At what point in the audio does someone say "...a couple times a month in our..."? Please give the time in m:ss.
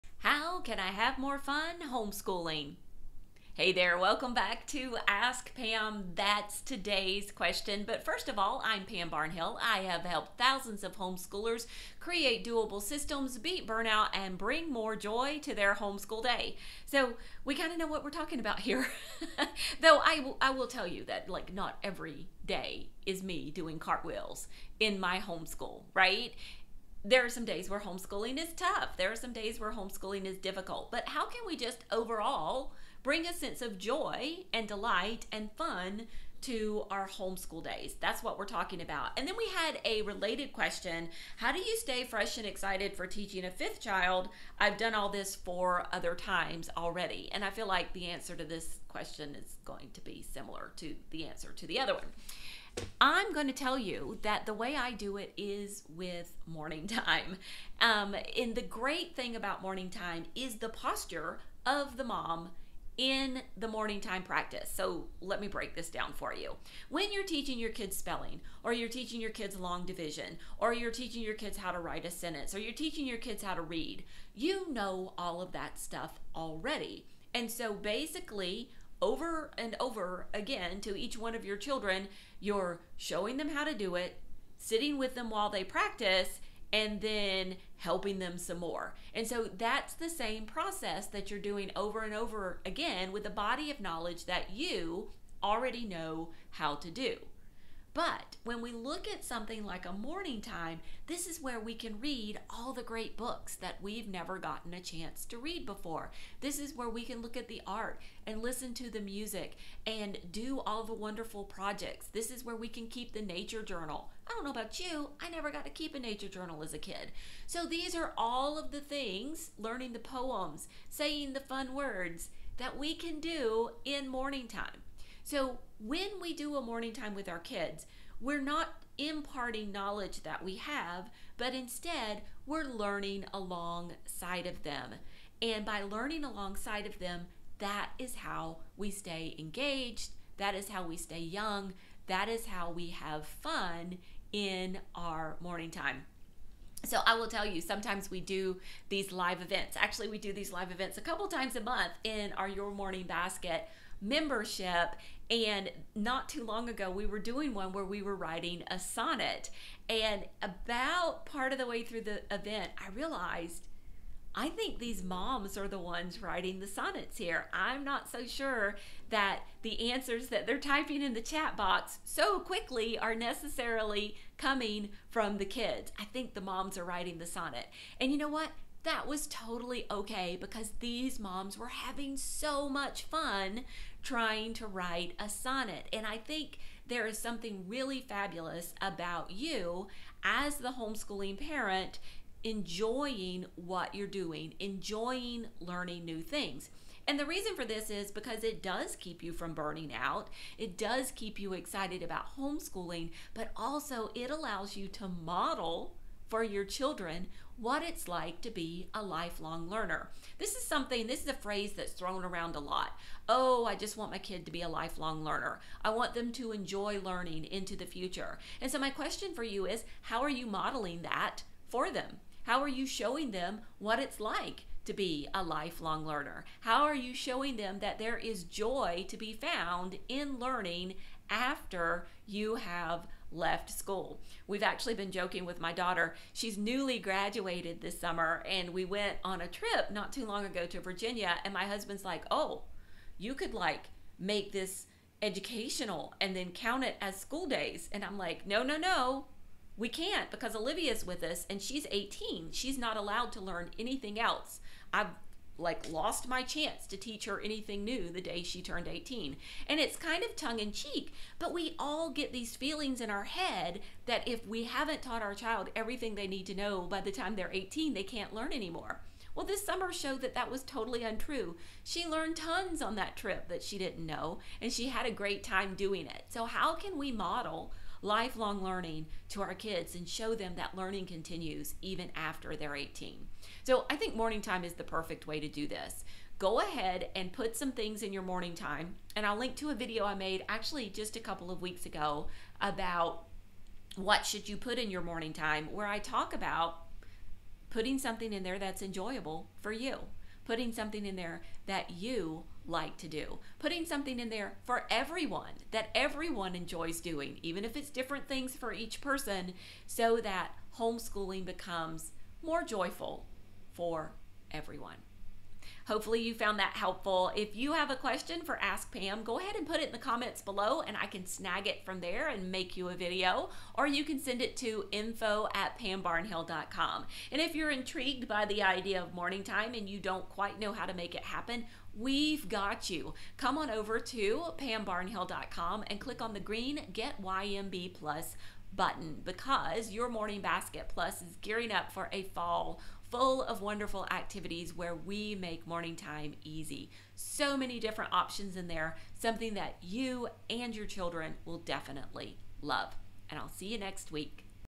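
2:30.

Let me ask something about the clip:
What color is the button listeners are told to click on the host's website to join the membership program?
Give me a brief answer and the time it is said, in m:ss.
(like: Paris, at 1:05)
Green, at 5:36.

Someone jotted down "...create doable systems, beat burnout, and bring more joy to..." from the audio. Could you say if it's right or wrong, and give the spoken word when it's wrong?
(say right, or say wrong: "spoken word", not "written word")
right.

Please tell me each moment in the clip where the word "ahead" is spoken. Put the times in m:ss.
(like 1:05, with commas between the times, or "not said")
4:46, 5:19.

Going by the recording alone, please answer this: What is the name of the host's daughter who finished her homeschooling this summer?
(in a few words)
Olivia.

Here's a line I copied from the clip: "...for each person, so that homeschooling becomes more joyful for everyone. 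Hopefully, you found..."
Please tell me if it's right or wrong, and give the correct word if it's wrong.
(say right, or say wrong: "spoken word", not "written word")
right.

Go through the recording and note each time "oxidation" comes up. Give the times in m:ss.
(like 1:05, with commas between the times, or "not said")
not said.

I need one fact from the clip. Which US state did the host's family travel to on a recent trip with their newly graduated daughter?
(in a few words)
Virginia.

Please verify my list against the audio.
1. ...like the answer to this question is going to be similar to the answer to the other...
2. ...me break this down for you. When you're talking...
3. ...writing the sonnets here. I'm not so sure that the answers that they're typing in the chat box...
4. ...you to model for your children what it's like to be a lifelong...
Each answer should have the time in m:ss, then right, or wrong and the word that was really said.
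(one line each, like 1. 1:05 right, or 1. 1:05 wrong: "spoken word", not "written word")
1. 0:47 right
2. 1:05 wrong: "teaching", not "talking"
3. 2:46 right
4. 3:24 right.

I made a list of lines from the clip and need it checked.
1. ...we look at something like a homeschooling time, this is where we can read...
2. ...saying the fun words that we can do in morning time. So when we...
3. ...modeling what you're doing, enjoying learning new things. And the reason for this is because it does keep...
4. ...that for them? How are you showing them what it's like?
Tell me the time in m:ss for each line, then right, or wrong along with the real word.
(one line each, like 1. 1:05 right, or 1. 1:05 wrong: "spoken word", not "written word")
1. 1:38 wrong: "morning", not "homeschooling"
2. 2:00 right
3. 3:12 wrong: "enjoying", not "modeling"
4. 3:41 right.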